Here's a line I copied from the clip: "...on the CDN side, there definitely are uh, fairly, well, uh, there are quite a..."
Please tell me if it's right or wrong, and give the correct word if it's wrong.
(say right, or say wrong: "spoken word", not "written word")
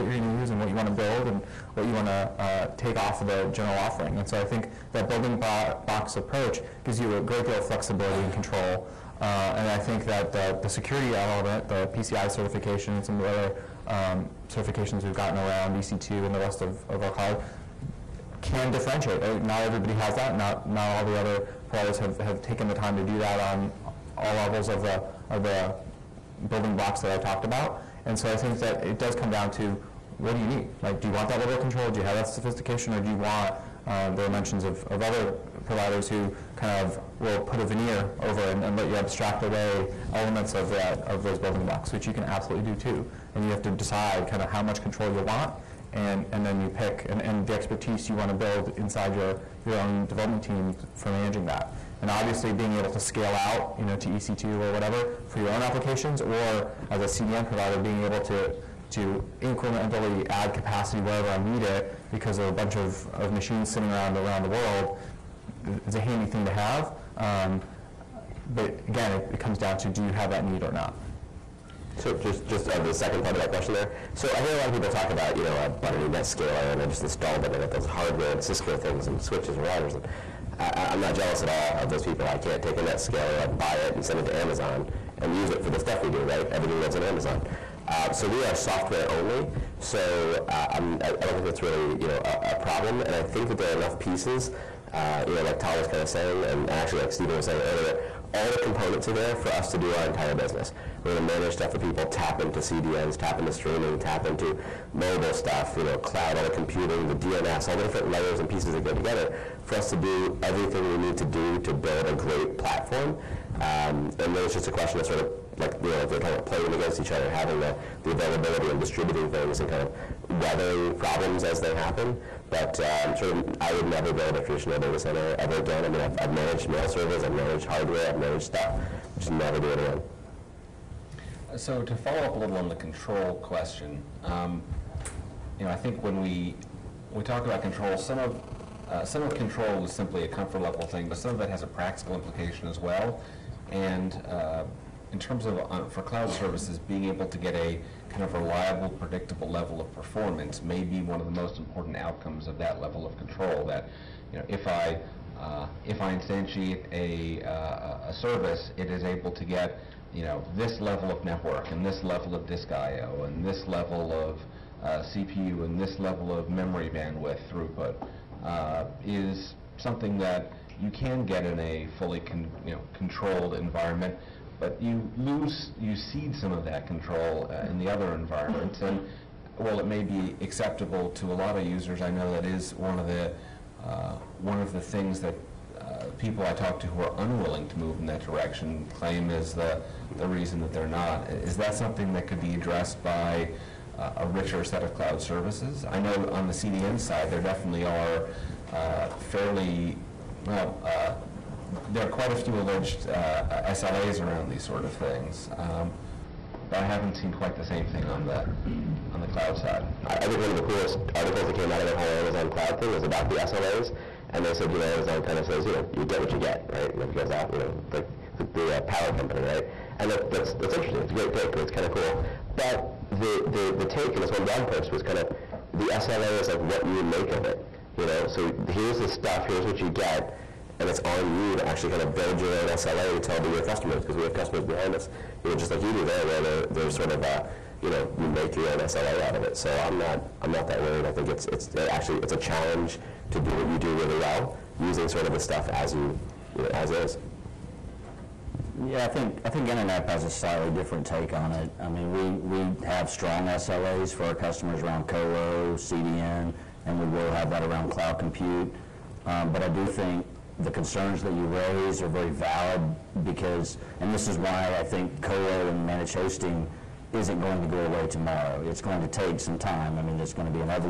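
right.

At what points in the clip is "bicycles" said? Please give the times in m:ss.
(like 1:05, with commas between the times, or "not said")
not said.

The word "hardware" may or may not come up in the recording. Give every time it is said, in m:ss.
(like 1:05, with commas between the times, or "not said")
1:17, 2:07.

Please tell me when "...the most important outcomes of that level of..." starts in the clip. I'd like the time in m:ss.
2:31.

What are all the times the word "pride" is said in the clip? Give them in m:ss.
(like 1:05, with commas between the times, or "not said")
not said.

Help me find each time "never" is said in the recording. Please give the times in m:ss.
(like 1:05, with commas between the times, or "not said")
2:03, 2:09.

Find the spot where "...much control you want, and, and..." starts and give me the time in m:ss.
0:44.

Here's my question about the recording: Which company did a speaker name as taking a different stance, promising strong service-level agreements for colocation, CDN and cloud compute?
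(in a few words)
Internap.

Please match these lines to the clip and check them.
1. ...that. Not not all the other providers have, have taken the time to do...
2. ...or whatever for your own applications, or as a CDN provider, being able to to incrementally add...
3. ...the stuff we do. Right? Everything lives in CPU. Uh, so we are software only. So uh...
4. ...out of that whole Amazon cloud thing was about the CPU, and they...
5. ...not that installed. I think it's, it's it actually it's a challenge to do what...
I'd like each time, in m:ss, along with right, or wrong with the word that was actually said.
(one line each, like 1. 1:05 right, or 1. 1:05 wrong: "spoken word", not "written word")
1. 0:20 right
2. 0:54 right
3. 1:25 wrong: "Amazon", not "CPU"
4. 3:31 wrong: "SLAs", not "CPU"
5. 4:00 wrong: "worried", not "installed".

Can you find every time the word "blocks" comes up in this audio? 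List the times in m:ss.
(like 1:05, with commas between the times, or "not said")
0:26, 0:41.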